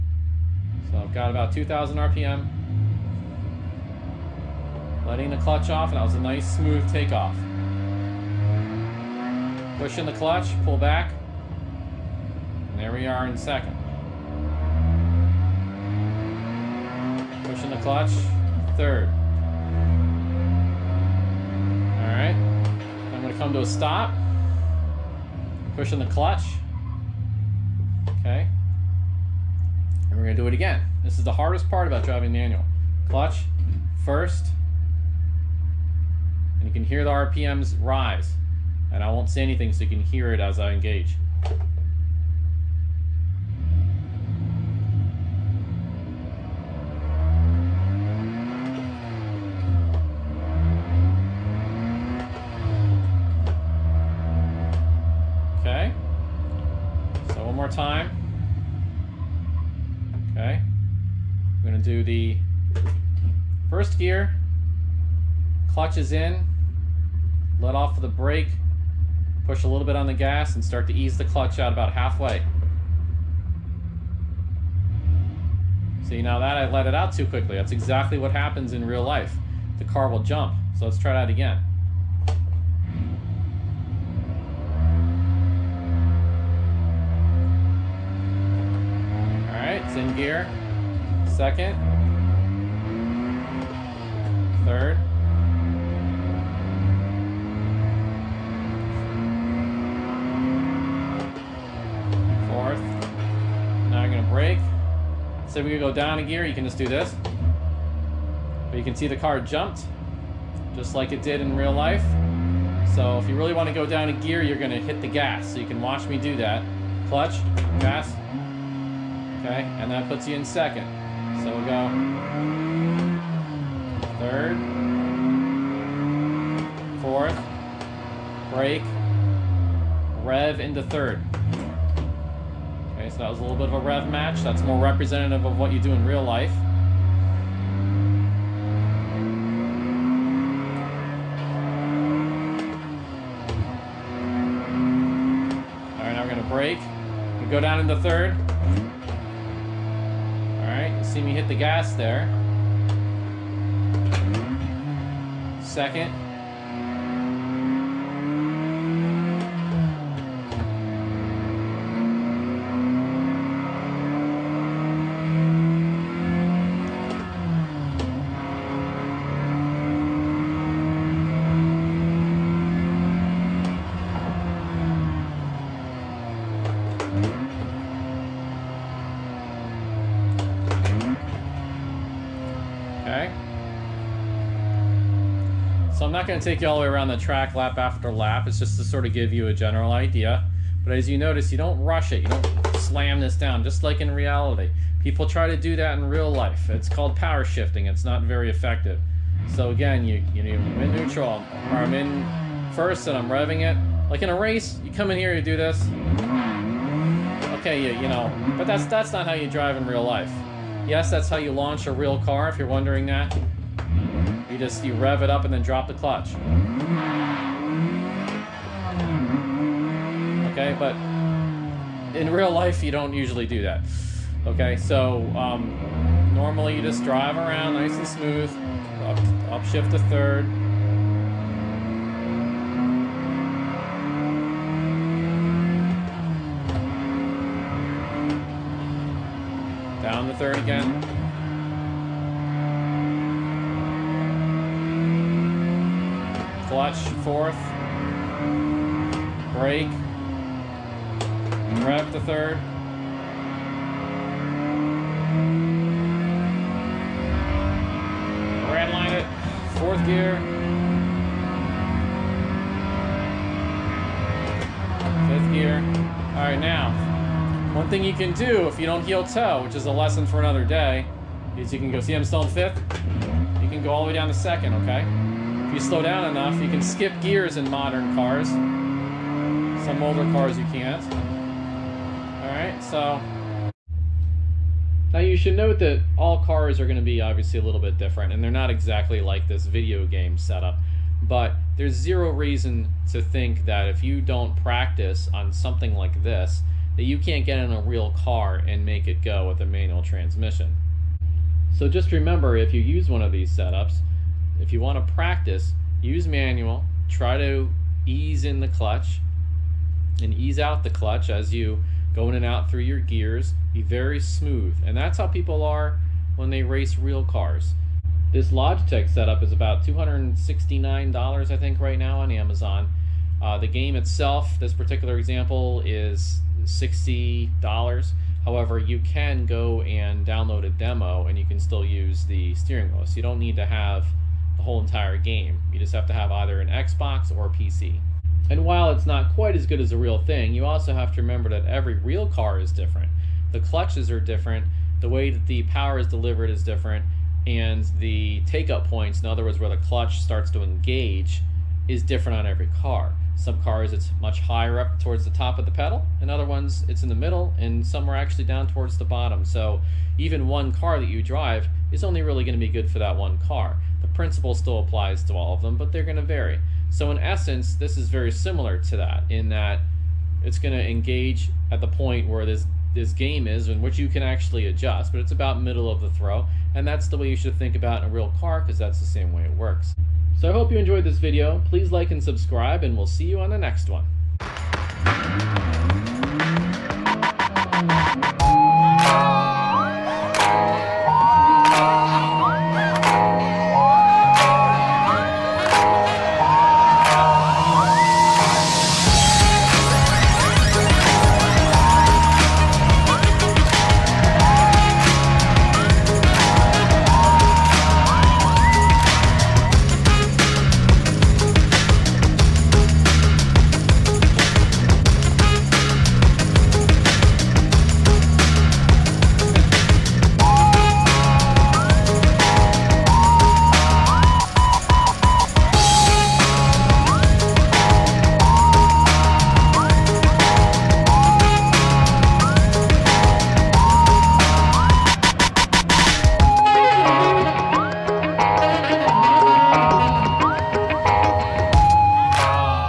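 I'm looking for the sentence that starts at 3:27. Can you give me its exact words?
Okay, you, you know, but that's, that's not how you drive in real life.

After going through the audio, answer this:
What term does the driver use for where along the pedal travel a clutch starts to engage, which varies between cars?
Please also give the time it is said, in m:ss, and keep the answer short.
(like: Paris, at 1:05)
take up points, at 5:48.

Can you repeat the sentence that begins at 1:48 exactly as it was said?
But you can see the car jumped, just like it did in real life.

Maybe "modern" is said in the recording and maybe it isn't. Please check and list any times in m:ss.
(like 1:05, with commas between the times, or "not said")
4:37.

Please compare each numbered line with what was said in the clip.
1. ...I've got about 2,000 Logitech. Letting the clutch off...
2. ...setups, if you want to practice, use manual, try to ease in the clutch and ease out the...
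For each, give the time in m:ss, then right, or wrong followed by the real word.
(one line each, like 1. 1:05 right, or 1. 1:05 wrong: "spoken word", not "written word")
1. 0:00 wrong: "RPM", not "Logitech"
2. 5:03 right.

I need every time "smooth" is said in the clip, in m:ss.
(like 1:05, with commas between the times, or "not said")
0:06, 3:48, 5:14.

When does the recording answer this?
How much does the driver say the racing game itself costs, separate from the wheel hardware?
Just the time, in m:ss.
5:26.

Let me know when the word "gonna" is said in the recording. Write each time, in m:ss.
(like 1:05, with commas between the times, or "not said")
0:23, 0:30, 2:26.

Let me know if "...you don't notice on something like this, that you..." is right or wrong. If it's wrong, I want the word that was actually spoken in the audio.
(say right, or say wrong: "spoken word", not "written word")
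wrong: "practice", not "notice".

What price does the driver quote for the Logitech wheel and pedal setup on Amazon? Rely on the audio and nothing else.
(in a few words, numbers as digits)
$269.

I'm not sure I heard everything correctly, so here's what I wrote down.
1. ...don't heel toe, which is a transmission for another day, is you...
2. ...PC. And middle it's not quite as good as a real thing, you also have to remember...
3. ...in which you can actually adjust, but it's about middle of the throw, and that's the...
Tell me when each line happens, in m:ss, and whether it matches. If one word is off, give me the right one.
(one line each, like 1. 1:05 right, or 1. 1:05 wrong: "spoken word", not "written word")
1. 4:28 wrong: "lesson", not "transmission"
2. 5:37 wrong: "while", not "middle"
3. 6:13 right.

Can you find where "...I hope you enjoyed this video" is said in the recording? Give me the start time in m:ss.
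6:20.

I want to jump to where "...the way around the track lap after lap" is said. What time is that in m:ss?
3:06.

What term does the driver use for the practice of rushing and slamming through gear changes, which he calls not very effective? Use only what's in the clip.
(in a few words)
power shifting.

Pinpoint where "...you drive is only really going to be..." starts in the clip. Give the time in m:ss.
6:01.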